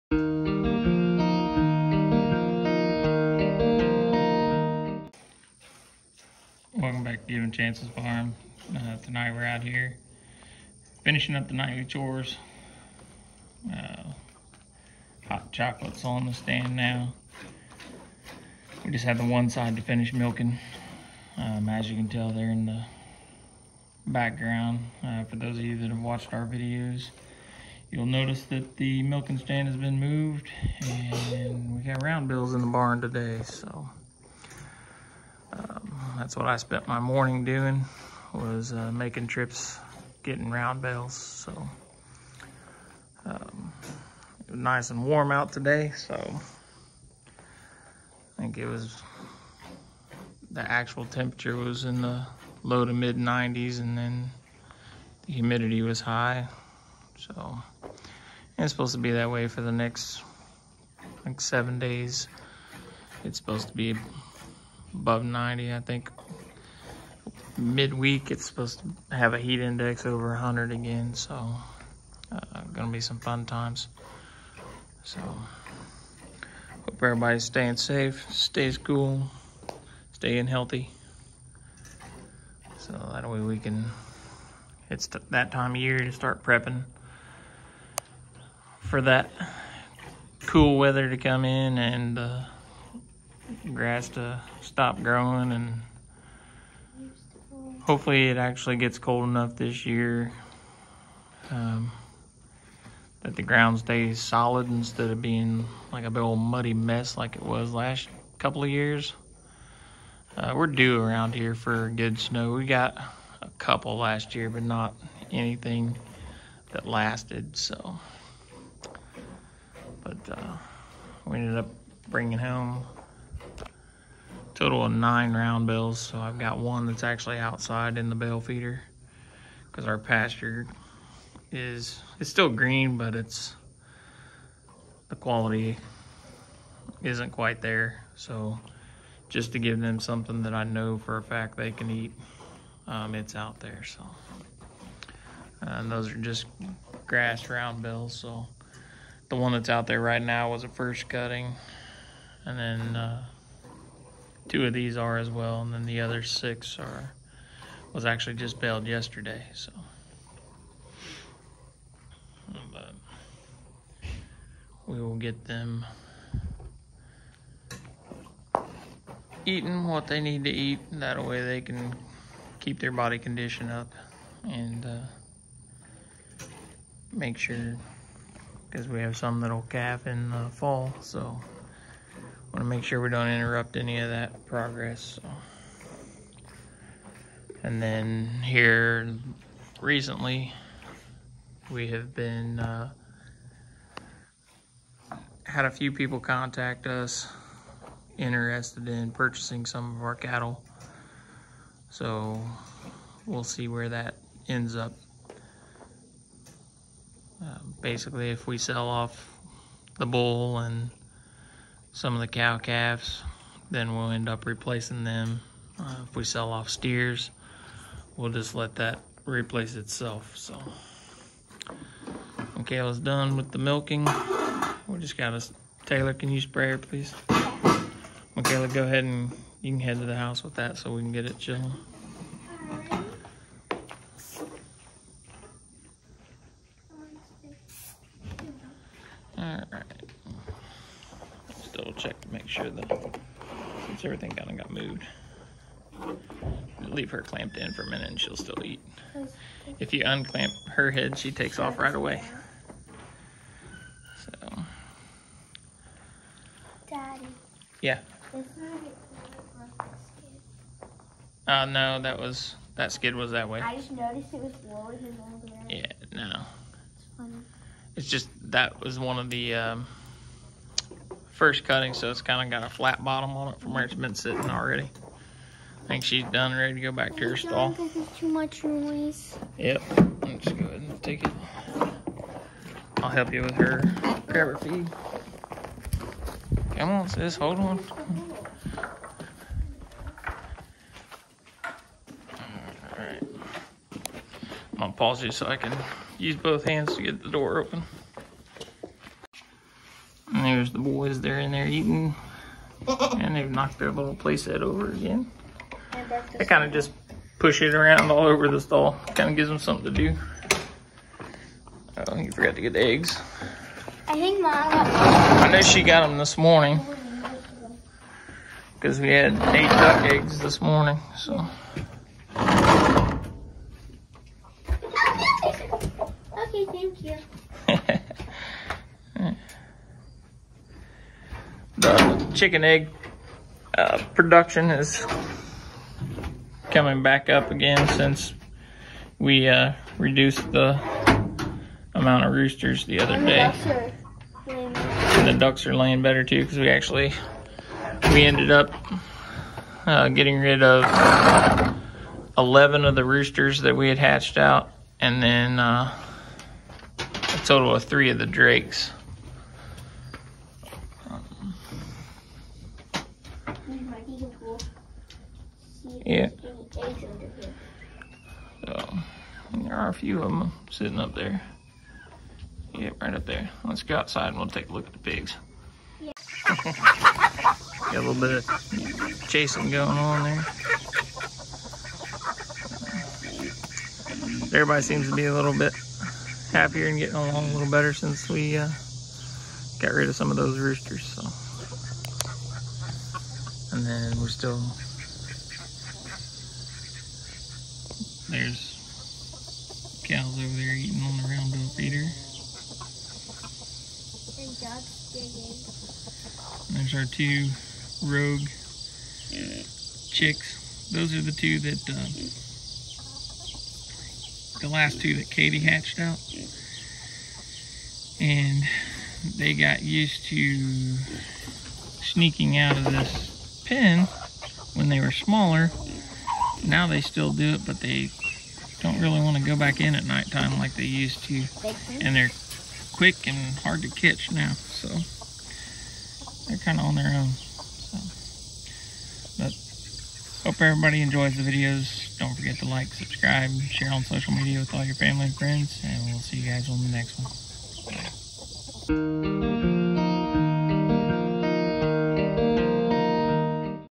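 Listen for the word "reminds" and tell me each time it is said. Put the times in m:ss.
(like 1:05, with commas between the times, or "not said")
not said.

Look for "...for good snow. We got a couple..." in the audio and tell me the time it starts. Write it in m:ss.
1:51.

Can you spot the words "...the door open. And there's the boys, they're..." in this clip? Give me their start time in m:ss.
4:57.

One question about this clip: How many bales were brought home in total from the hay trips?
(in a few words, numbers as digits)
9.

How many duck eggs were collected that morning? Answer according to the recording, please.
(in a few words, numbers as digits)
8.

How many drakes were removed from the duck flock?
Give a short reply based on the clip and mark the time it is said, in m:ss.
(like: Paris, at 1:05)
3, at 5:57.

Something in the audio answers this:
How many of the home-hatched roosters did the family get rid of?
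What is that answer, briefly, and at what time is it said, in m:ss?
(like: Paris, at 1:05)
11, at 5:52.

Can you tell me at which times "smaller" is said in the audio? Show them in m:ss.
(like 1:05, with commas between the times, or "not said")
7:05.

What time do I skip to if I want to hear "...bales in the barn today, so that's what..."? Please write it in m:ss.
0:32.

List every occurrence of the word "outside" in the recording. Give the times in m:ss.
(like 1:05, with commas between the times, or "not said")
2:07, 6:13.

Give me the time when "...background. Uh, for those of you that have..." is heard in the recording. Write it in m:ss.
0:24.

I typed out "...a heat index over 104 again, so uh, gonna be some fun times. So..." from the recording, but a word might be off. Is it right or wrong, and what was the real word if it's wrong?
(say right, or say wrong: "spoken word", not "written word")
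wrong: "100", not "104".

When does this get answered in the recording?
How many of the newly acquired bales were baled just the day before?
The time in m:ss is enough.
2:36.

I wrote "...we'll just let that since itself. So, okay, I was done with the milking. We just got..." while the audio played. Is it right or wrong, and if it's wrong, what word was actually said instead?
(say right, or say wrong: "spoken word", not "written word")
wrong: "replace", not "since".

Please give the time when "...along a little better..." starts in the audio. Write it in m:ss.
6:27.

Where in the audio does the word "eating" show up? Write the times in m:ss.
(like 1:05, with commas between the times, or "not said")
2:49, 5:01, 6:40.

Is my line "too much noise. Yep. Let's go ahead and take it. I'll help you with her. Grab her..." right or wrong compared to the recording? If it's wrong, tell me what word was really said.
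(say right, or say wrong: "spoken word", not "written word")
right.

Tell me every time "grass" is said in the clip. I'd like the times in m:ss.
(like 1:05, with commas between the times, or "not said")
1:33, 2:27.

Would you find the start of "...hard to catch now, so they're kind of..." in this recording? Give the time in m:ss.
7:13.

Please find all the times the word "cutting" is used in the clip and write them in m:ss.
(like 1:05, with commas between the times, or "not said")
2:31, 4:31.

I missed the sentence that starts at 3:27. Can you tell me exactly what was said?
Uh, basically, if we sell off the bull and some of the cow calves.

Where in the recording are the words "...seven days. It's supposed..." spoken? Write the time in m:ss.
1:01.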